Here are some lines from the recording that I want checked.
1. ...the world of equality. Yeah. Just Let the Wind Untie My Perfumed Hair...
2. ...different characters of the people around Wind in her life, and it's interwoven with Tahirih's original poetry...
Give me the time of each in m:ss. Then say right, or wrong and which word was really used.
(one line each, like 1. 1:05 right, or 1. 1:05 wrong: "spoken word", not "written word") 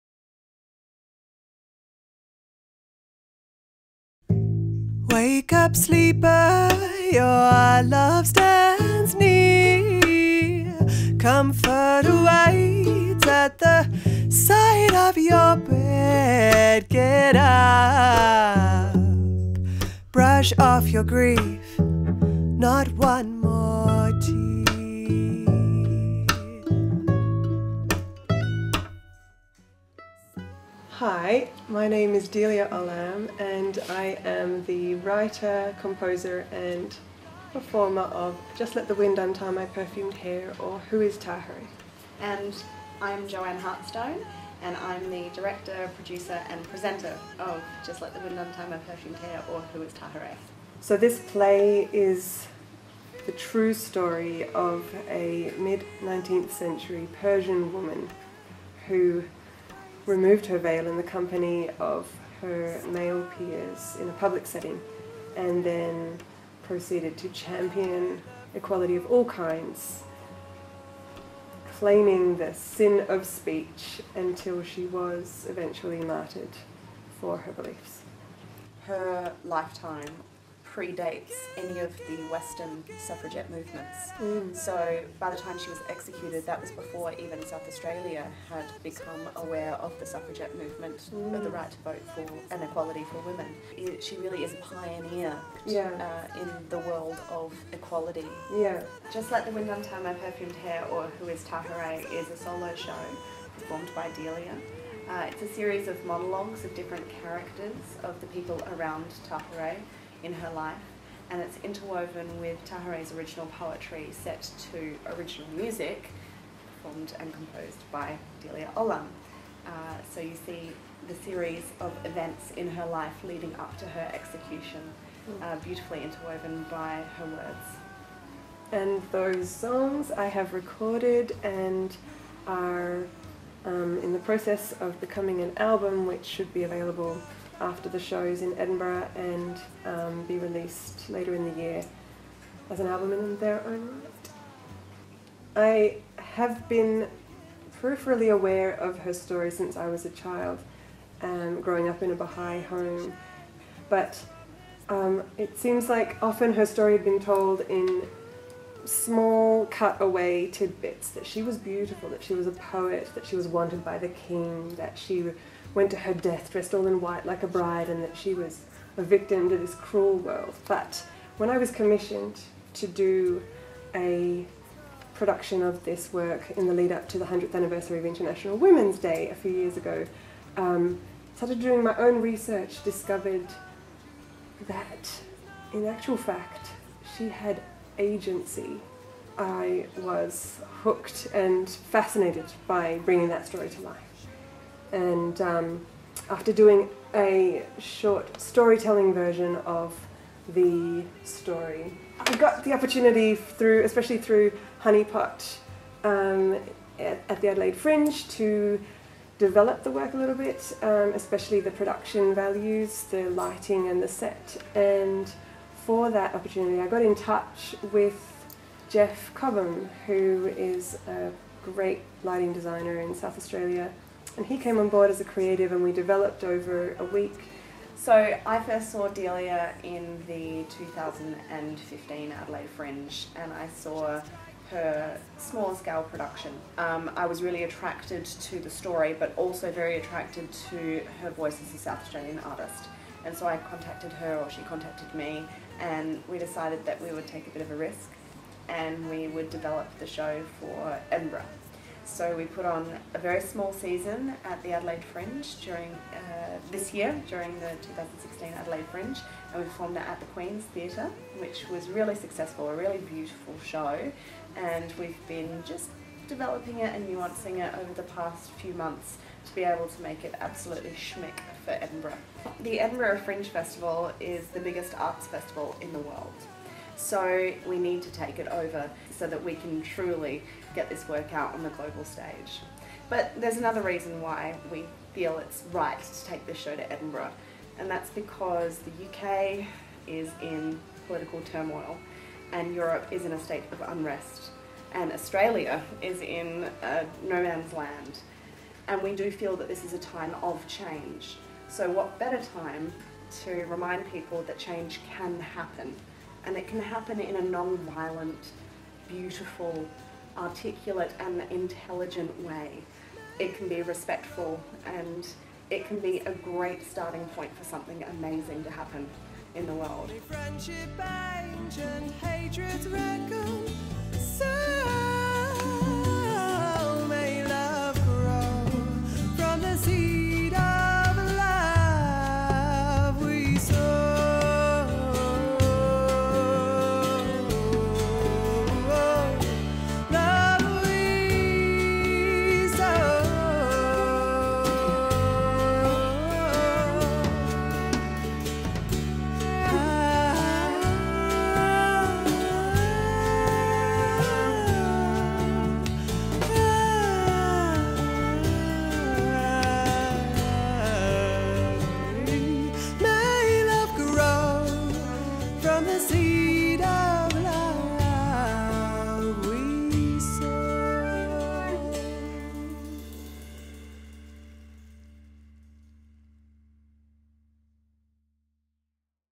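1. 1:36 right
2. 1:46 wrong: "Tahirih", not "Wind".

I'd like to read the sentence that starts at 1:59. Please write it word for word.
Uh, so you see the series of events in her life leading up to her execution, uh, beautifully interwoven by her words.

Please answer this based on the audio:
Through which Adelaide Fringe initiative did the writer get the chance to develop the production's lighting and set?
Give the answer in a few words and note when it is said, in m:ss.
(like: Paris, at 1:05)
Honeypot, at 3:24.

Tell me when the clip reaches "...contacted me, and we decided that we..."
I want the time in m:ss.
4:04.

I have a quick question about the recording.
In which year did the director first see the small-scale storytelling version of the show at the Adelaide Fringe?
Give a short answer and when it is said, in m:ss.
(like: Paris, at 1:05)
2015, at 3:50.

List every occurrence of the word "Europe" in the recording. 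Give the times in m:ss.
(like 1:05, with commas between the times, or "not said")
4:52.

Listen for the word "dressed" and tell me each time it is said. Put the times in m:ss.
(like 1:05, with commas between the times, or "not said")
2:46.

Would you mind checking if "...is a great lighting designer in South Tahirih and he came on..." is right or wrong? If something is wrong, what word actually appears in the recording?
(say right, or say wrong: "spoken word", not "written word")
wrong: "Australia", not "Tahirih".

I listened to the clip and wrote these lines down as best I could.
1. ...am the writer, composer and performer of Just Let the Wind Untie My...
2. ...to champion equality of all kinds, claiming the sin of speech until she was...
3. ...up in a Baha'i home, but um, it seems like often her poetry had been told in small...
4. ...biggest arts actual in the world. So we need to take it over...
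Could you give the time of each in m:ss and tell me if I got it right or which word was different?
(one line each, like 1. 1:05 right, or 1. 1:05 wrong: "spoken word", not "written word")
1. 0:34 right
2. 1:07 right
3. 2:31 wrong: "story", not "poetry"
4. 4:34 wrong: "festival", not "actual".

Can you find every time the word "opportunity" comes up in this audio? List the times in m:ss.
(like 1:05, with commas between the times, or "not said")
3:22, 3:36.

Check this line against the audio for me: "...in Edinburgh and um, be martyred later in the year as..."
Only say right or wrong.
wrong.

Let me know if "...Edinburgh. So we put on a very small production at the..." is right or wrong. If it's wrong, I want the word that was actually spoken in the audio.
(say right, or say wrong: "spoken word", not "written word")
wrong: "season", not "production".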